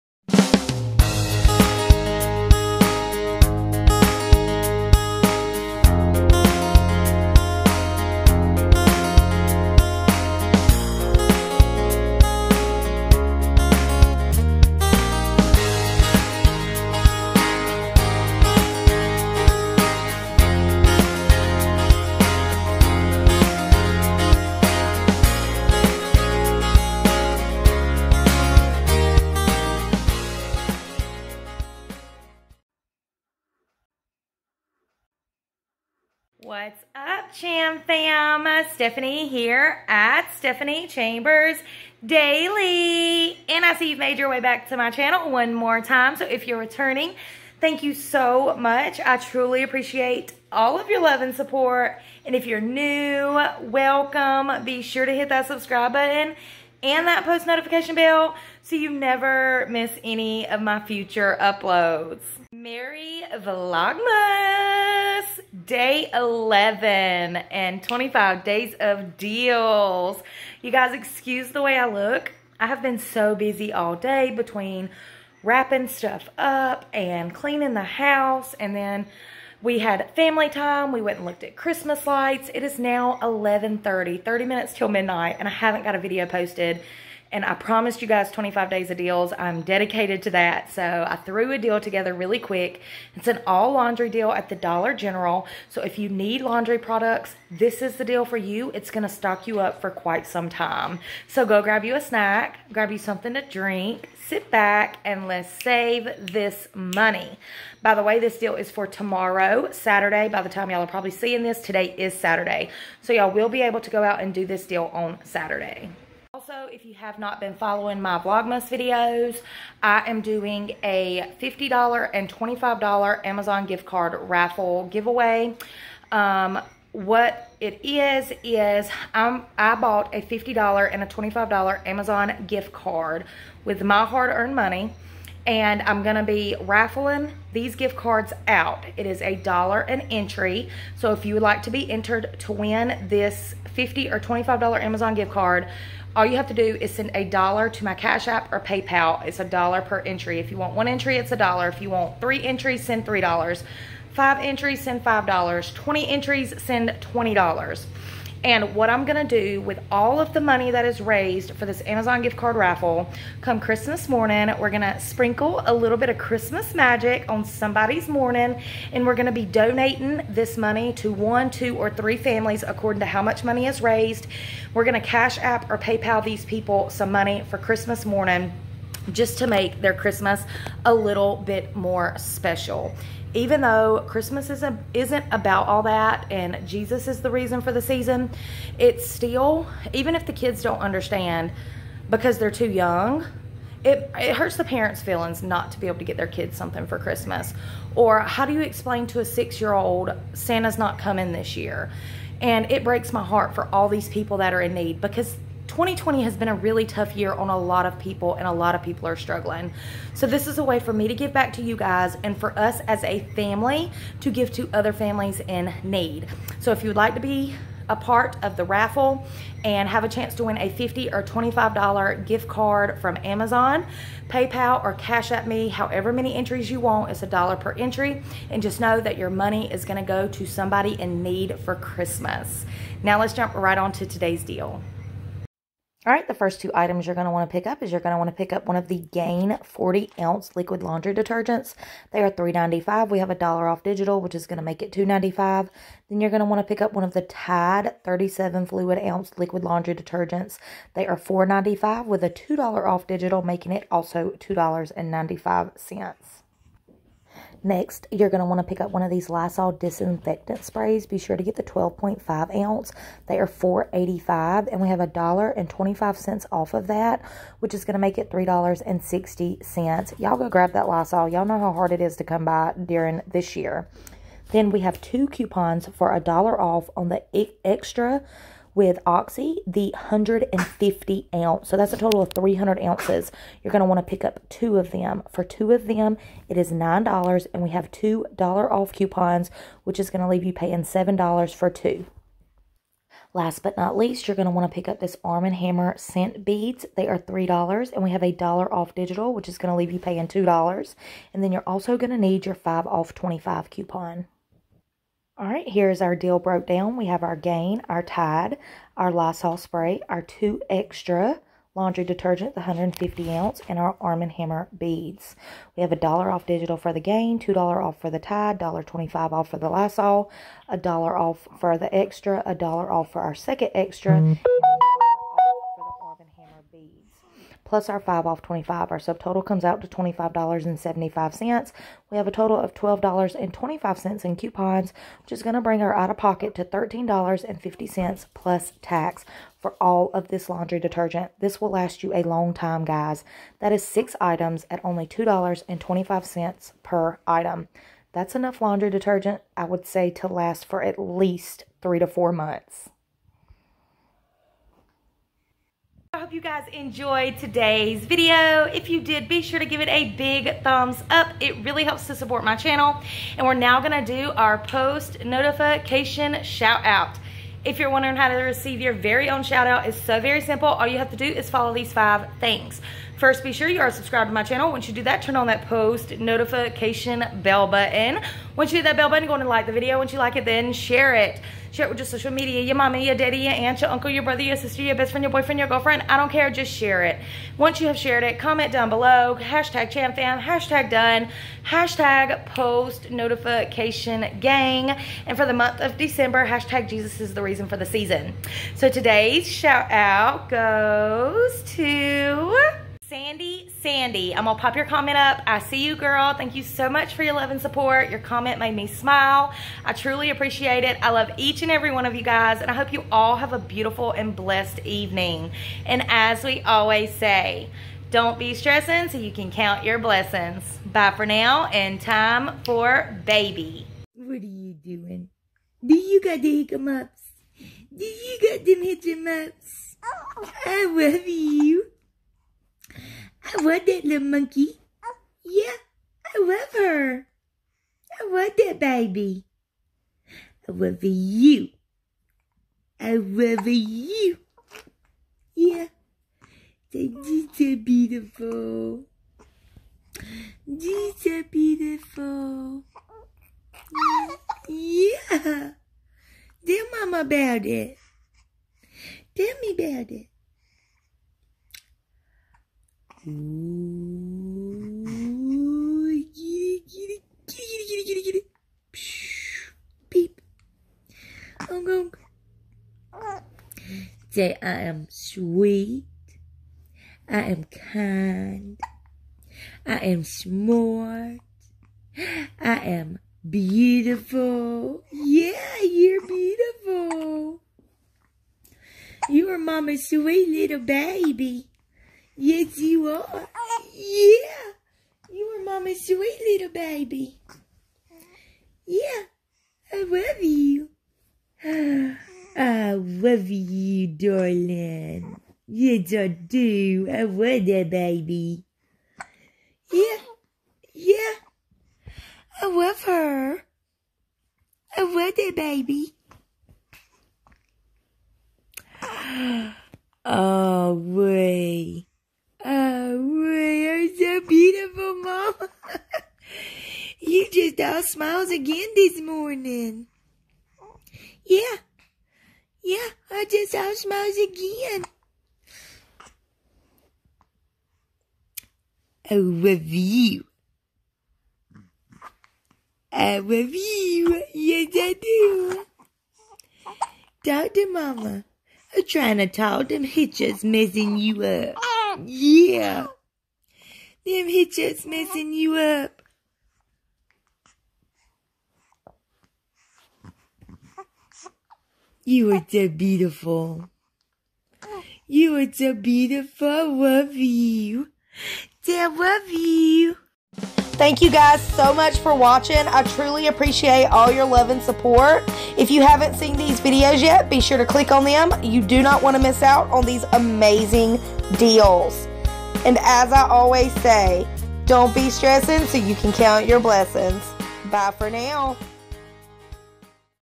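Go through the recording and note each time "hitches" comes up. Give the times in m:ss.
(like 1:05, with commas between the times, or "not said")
9:10, 9:14.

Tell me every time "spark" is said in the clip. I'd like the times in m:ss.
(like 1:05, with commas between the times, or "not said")
not said.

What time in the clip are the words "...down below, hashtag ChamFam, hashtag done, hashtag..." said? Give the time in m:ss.
6:28.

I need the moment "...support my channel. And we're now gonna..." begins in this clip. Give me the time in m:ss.
6:02.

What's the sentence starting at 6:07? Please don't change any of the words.
If you're wondering how to receive your very own shout out, it's so very simple.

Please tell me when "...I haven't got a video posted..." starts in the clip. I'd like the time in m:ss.
1:25.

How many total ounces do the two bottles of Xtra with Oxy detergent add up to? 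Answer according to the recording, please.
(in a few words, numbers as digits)
300 ounces.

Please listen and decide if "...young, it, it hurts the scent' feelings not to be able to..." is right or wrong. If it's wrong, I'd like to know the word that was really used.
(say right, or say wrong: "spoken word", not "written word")
wrong: "parents", not "scent".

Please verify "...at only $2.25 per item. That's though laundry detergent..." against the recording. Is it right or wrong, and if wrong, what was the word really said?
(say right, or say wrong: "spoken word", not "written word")
wrong: "enough", not "though".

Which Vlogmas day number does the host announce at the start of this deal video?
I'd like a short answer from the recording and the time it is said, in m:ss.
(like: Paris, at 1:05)
Day 11, at 1:05.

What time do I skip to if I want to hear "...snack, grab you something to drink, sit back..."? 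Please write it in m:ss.
1:42.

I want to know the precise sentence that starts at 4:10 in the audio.
They are $4.95 with a $2 off digital, making it also $2.95.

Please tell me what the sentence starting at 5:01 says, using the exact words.
And then you're also going to need your 5 off 25 coupon.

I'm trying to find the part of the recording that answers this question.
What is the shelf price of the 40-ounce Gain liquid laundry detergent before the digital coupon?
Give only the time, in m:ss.
4:02.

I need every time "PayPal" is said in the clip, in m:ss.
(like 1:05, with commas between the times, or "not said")
2:28, 2:55, 3:44.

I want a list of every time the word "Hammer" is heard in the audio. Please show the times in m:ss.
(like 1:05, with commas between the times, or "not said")
4:55, 5:14.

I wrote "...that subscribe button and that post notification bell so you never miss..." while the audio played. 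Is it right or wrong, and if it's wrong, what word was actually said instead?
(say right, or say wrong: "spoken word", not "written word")
right.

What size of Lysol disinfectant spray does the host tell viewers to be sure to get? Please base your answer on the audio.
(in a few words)
12.5 ounce.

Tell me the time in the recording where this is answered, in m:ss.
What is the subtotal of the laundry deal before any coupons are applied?
5:29.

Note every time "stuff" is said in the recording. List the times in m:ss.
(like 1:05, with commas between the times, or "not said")
1:15.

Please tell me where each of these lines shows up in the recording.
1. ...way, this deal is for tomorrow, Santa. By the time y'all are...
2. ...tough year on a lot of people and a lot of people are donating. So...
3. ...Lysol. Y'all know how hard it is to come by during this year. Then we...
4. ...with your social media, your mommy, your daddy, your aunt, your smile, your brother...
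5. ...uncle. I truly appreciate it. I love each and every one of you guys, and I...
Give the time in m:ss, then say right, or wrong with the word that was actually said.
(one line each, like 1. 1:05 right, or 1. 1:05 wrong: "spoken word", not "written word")
1. 1:48 wrong: "Saturday", not "Santa"
2. 3:26 wrong: "struggling", not "donating"
3. 4:30 right
4. 6:21 wrong: "uncle", not "smile"
5. 6:48 wrong: "smile", not "uncle".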